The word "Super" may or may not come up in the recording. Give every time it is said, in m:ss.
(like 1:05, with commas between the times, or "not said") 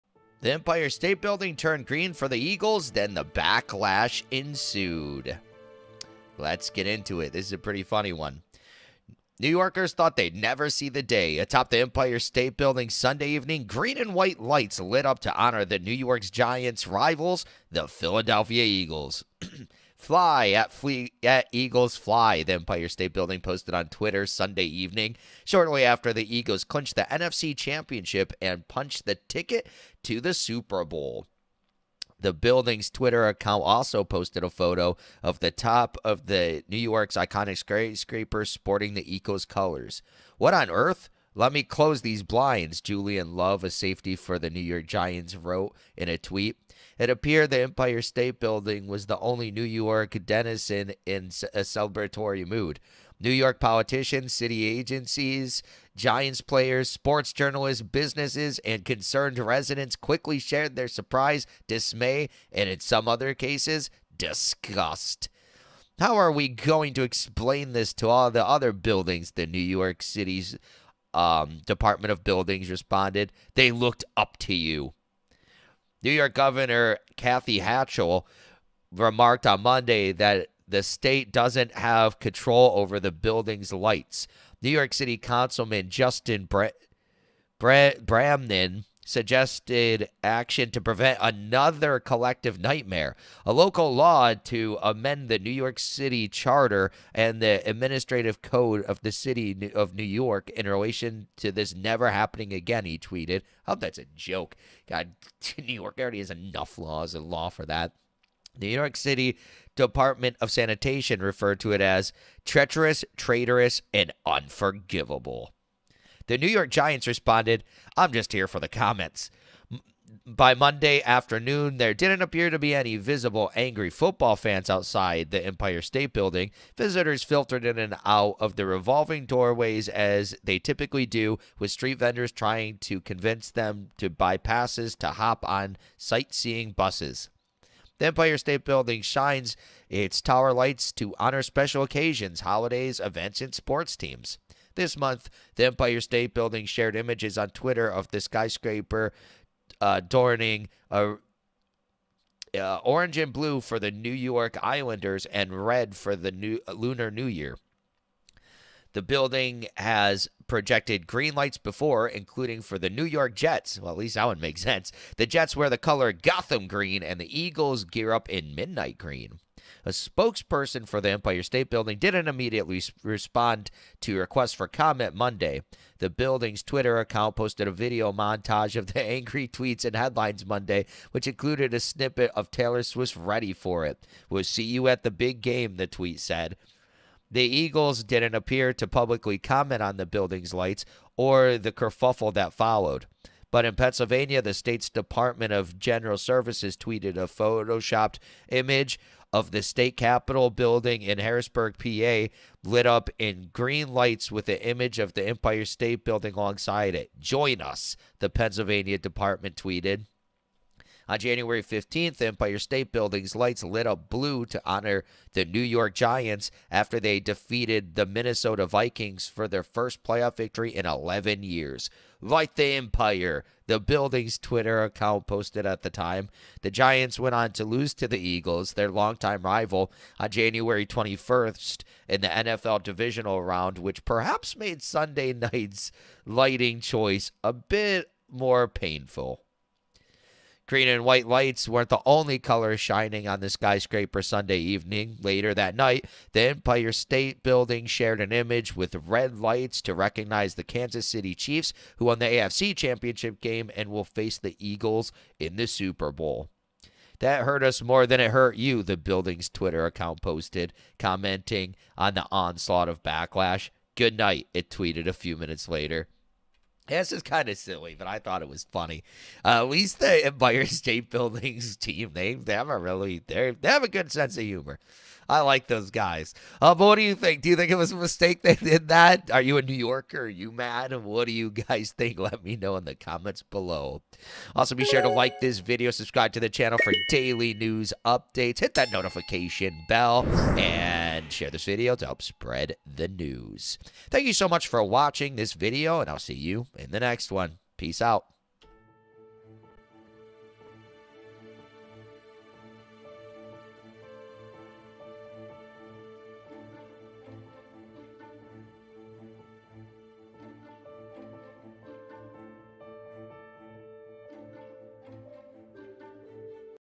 0:30, 4:15.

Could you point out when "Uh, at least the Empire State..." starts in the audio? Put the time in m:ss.
4:29.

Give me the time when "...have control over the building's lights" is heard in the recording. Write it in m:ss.
1:21.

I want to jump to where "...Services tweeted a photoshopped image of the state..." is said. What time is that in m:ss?
3:16.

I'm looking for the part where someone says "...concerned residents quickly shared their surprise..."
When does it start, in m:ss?
0:58.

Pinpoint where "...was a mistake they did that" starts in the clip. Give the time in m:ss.
4:37.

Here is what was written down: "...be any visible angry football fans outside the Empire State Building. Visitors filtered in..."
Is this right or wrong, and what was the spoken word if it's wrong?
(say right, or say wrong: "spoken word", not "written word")
right.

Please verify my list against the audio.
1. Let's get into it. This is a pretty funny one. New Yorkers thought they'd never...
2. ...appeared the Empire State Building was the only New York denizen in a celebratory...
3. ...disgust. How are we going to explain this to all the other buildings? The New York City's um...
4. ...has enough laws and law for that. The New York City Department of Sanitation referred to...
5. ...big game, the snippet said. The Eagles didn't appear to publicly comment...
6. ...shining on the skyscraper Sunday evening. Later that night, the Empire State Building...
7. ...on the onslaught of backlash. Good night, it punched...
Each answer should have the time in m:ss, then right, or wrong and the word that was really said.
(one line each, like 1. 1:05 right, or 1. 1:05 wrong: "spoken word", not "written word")
1. 0:06 right
2. 0:47 right
3. 1:04 right
4. 1:46 right
5. 3:05 wrong: "tweet", not "snippet"
6. 4:02 right
7. 4:21 wrong: "tweeted", not "punched".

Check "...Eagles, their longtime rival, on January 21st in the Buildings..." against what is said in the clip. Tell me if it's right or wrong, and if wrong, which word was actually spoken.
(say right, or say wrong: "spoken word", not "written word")
wrong: "NFL", not "Buildings".